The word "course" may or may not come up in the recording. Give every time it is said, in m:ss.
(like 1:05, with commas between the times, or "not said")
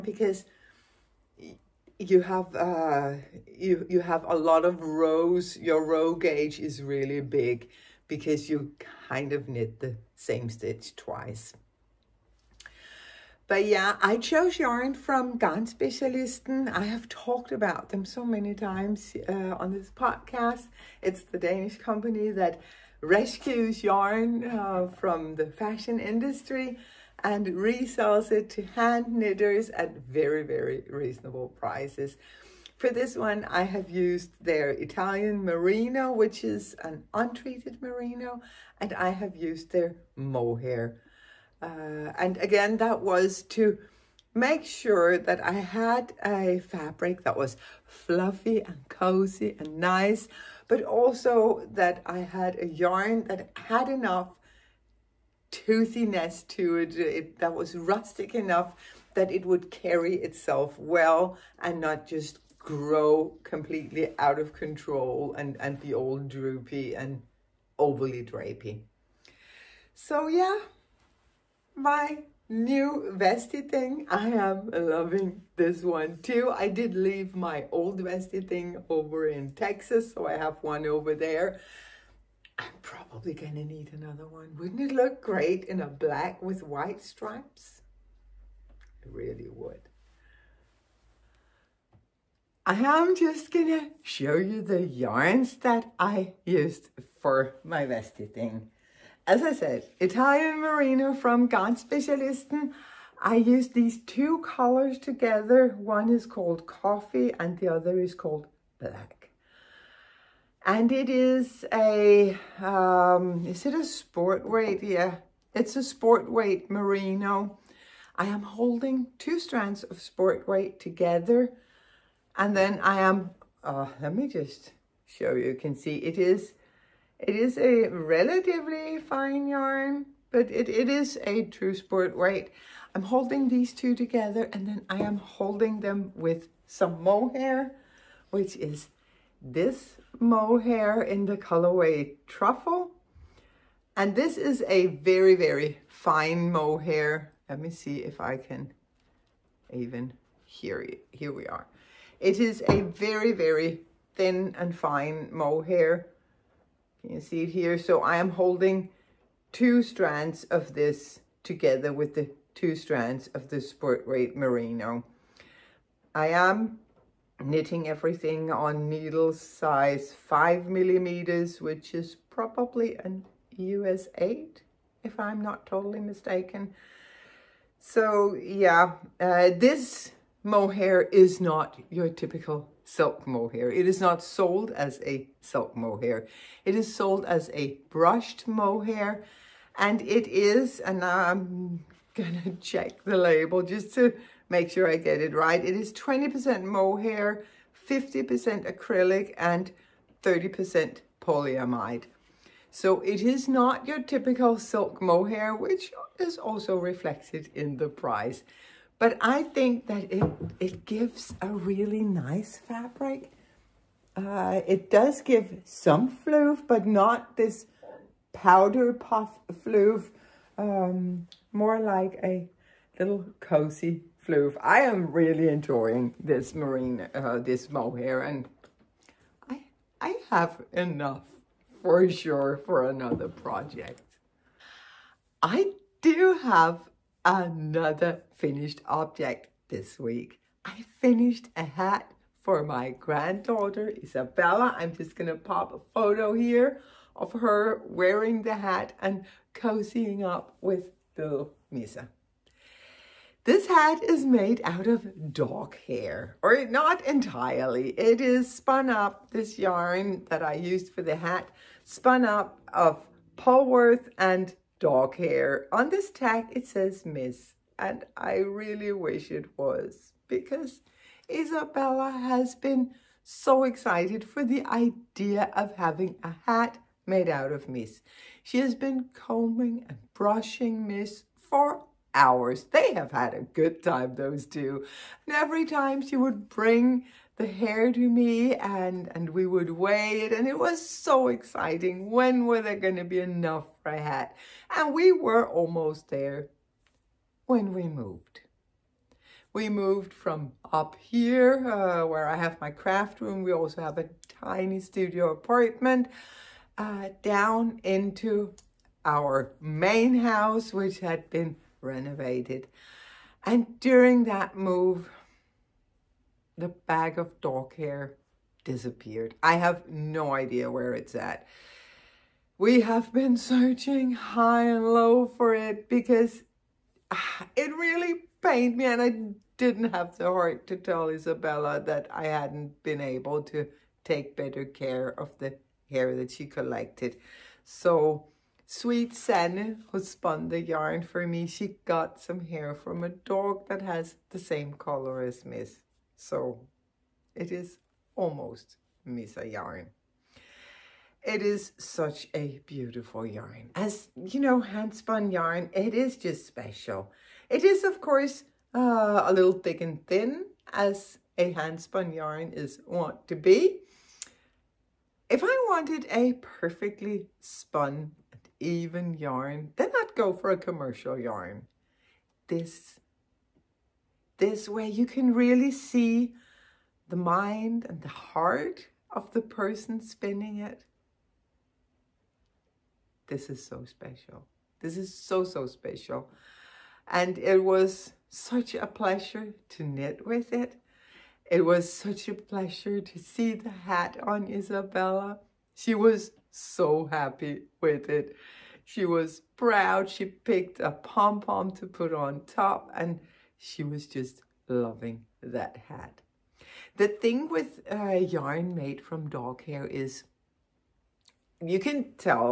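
5:58.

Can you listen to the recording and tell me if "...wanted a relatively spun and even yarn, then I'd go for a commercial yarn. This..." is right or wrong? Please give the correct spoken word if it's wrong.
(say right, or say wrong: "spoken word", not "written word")
wrong: "perfectly", not "relatively".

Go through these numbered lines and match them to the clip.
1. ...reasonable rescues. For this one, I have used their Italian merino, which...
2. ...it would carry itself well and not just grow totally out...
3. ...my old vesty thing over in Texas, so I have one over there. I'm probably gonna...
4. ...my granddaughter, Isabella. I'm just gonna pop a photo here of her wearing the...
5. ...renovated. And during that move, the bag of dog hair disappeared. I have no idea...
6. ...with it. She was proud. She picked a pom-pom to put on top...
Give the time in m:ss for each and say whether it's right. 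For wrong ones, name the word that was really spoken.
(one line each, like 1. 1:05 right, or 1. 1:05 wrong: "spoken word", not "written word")
1. 0:30 wrong: "prices", not "rescues"
2. 0:59 wrong: "completely", not "totally"
3. 1:17 right
4. 4:02 right
5. 5:11 right
6. 6:37 right.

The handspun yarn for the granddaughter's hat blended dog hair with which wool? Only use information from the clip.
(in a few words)
Polworth.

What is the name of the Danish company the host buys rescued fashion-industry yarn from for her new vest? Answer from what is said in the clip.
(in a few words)
Specialisten.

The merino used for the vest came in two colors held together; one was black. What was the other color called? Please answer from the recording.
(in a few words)
Coffee.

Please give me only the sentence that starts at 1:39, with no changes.
As I said, Italian Merino from Garnspecialisten.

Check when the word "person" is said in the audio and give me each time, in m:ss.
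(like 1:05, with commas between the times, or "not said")
6:19.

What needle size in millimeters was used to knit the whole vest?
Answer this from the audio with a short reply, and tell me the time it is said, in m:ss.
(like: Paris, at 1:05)
5 millimeters, at 2:50.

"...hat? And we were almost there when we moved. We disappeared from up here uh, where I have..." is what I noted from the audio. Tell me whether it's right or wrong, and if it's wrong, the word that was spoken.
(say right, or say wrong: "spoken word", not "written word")
wrong: "moved", not "disappeared".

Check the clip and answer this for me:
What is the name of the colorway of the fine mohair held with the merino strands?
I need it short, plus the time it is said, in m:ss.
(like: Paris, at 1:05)
Truffle, at 2:22.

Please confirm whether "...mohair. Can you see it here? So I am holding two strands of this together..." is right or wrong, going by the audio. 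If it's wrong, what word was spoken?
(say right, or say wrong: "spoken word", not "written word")
right.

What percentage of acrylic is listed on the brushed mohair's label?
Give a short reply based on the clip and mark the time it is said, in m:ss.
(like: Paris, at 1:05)
50%, at 3:17.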